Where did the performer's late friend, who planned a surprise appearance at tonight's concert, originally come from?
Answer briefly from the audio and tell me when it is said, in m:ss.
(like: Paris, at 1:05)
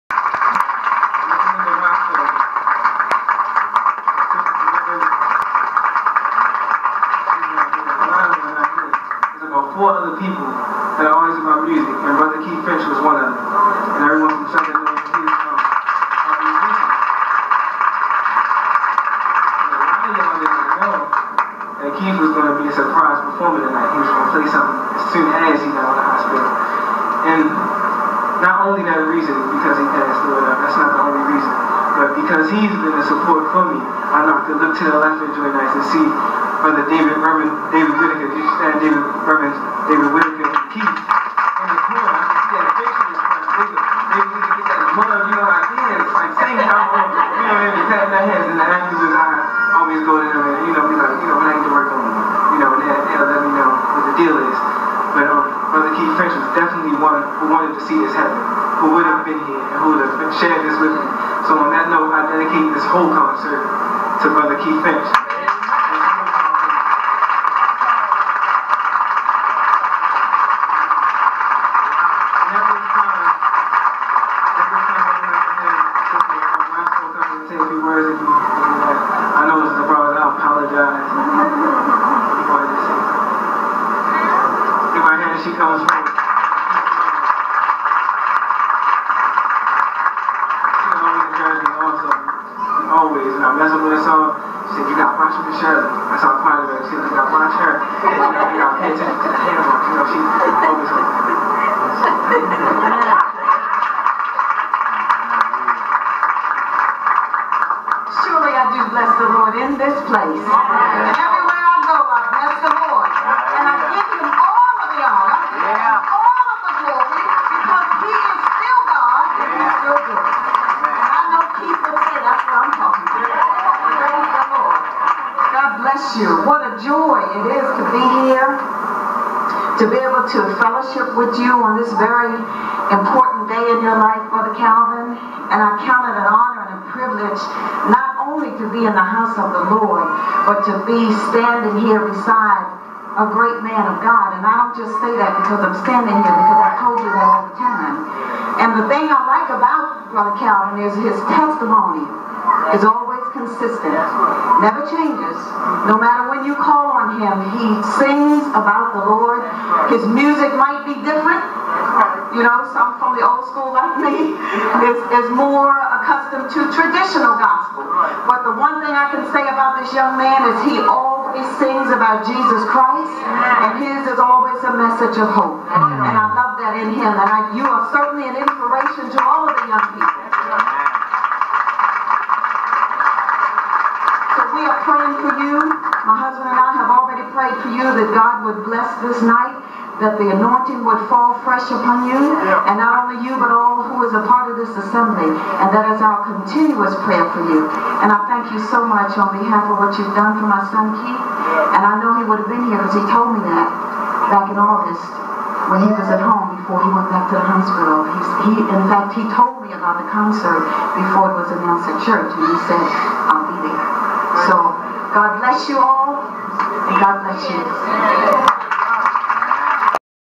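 Southern Illinois, at 0:14.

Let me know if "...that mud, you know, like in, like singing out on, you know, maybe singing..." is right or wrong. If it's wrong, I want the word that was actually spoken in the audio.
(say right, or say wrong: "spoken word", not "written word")
wrong: "tapping", not "singing".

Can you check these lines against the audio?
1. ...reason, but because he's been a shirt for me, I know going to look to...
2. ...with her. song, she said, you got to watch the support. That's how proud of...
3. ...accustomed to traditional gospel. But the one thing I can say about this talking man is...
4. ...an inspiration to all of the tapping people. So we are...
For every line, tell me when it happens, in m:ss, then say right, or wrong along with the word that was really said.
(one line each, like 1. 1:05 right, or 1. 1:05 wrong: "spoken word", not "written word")
1. 0:31 wrong: "support", not "shirt"
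2. 1:33 wrong: "shirt", not "support"
3. 2:45 wrong: "young", not "talking"
4. 2:58 wrong: "young", not "tapping".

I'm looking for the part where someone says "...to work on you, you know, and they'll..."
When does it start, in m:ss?
0:51.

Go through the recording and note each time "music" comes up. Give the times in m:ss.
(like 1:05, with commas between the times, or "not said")
0:11, 2:40.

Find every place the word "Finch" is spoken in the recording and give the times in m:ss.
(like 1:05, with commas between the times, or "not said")
0:12, 0:56, 1:04.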